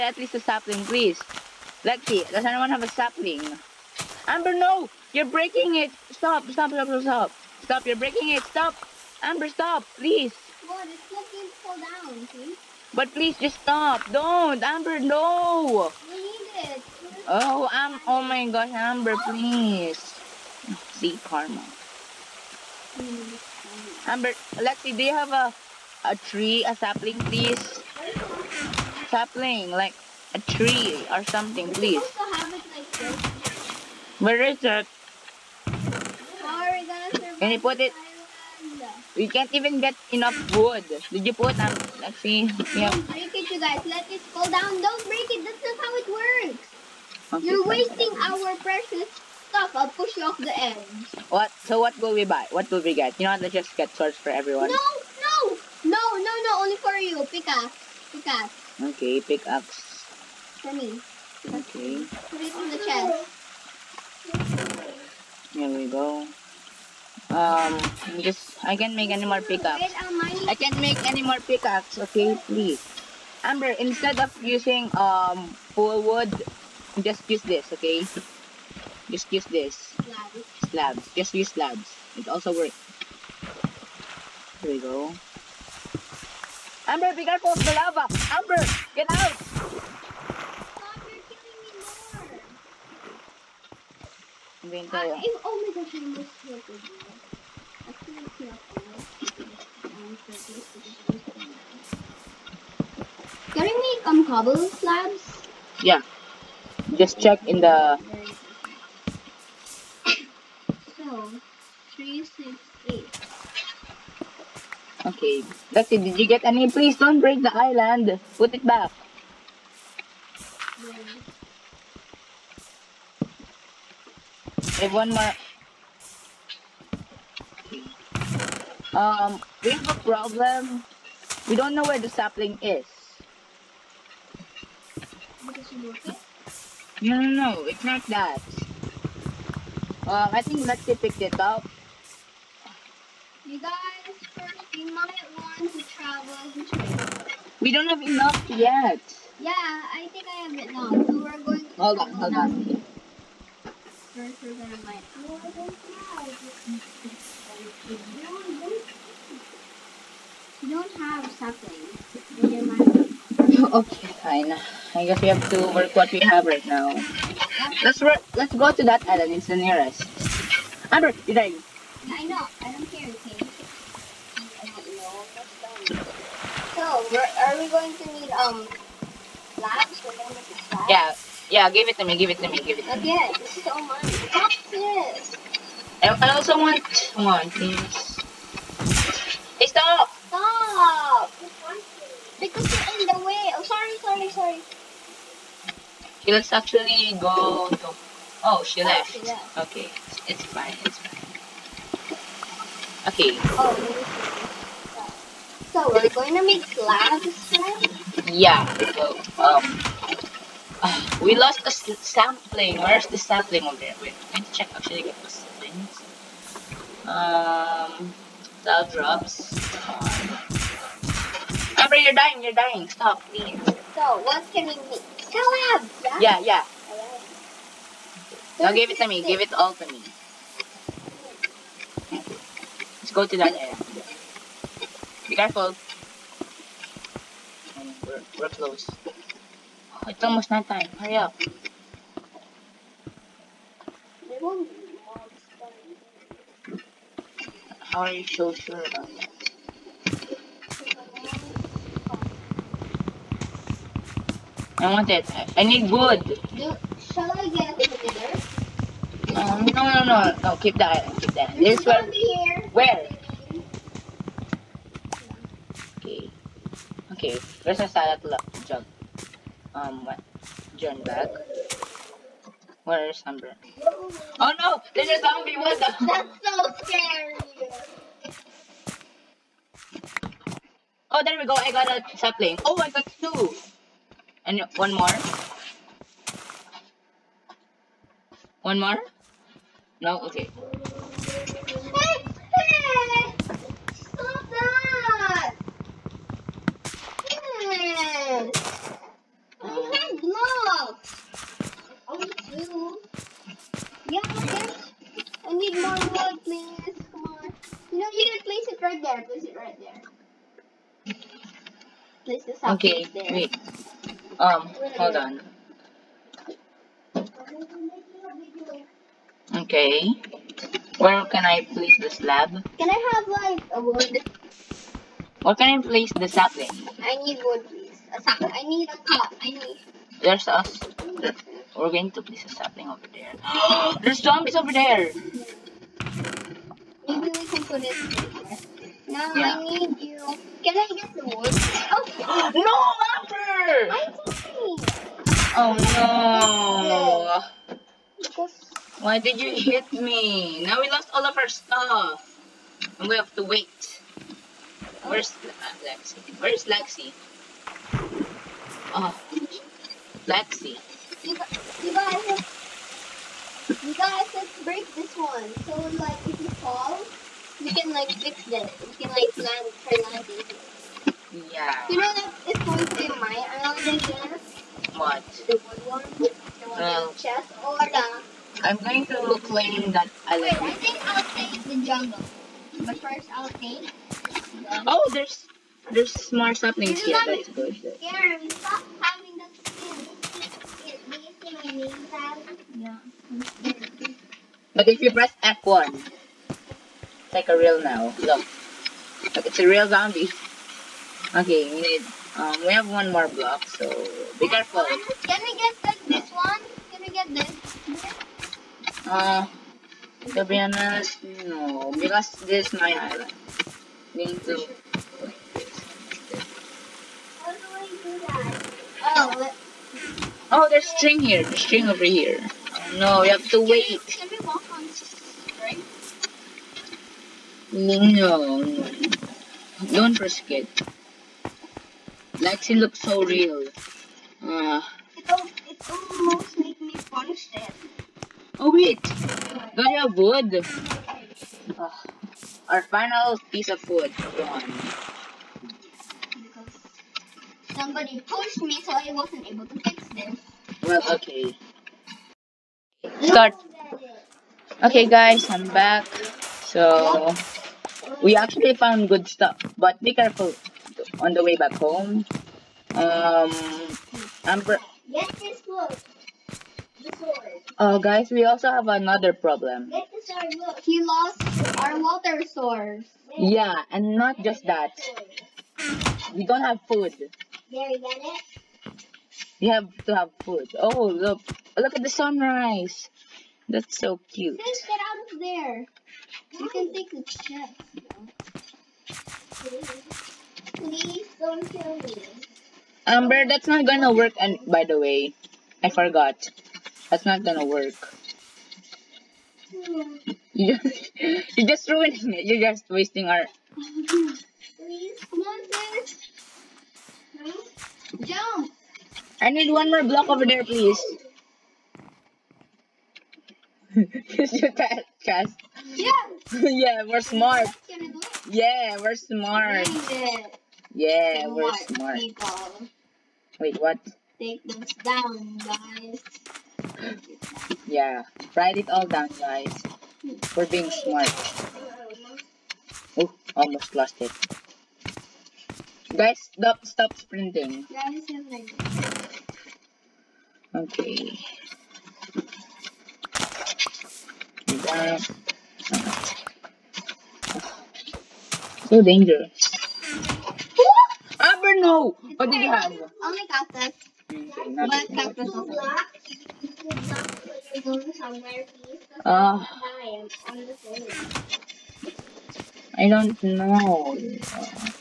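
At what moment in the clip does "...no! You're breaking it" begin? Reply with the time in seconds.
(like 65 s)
4 s.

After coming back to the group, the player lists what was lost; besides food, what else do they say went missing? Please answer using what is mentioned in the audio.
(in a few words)
water source.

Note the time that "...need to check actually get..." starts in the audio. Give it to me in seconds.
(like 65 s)
214 s.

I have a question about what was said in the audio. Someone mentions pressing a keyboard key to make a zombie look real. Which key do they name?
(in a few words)
F1.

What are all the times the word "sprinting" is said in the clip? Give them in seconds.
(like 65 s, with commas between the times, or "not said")
537 s.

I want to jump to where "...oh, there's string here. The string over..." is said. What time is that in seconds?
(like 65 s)
420 s.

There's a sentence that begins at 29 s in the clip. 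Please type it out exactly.
Stop playing like a tree or something, please.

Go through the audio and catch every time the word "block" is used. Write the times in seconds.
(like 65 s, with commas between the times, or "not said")
403 s, 510 s.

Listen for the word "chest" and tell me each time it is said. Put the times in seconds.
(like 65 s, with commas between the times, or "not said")
62 s, 377 s, 487 s, 515 s.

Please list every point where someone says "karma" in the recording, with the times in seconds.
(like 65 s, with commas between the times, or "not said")
21 s.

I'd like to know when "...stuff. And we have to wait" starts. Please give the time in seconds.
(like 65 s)
351 s.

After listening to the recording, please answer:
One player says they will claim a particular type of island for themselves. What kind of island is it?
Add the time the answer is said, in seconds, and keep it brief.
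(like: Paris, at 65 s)
jungle, at 381 s.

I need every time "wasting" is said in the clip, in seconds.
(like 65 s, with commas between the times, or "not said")
47 s, 502 s.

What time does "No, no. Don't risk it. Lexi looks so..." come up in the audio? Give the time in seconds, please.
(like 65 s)
427 s.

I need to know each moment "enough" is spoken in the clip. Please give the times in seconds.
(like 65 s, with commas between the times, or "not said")
40 s, 148 s.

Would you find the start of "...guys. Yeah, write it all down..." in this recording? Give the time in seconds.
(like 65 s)
525 s.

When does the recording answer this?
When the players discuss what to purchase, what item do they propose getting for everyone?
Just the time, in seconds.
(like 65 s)
53 s.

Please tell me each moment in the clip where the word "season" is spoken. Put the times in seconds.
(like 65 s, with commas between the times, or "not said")
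not said.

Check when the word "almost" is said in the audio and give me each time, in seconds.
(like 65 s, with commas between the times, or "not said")
240 s, 436 s, 533 s.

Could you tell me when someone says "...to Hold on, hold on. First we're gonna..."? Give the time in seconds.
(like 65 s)
151 s.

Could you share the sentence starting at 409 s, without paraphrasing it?
Uh, to be honest, no, because this is my island.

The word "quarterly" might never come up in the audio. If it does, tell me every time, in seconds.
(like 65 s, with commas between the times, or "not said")
not said.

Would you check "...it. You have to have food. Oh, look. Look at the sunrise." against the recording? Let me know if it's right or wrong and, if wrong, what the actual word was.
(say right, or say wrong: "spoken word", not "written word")
right.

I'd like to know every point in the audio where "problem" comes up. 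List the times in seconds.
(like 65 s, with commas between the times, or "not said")
130 s, 469 s.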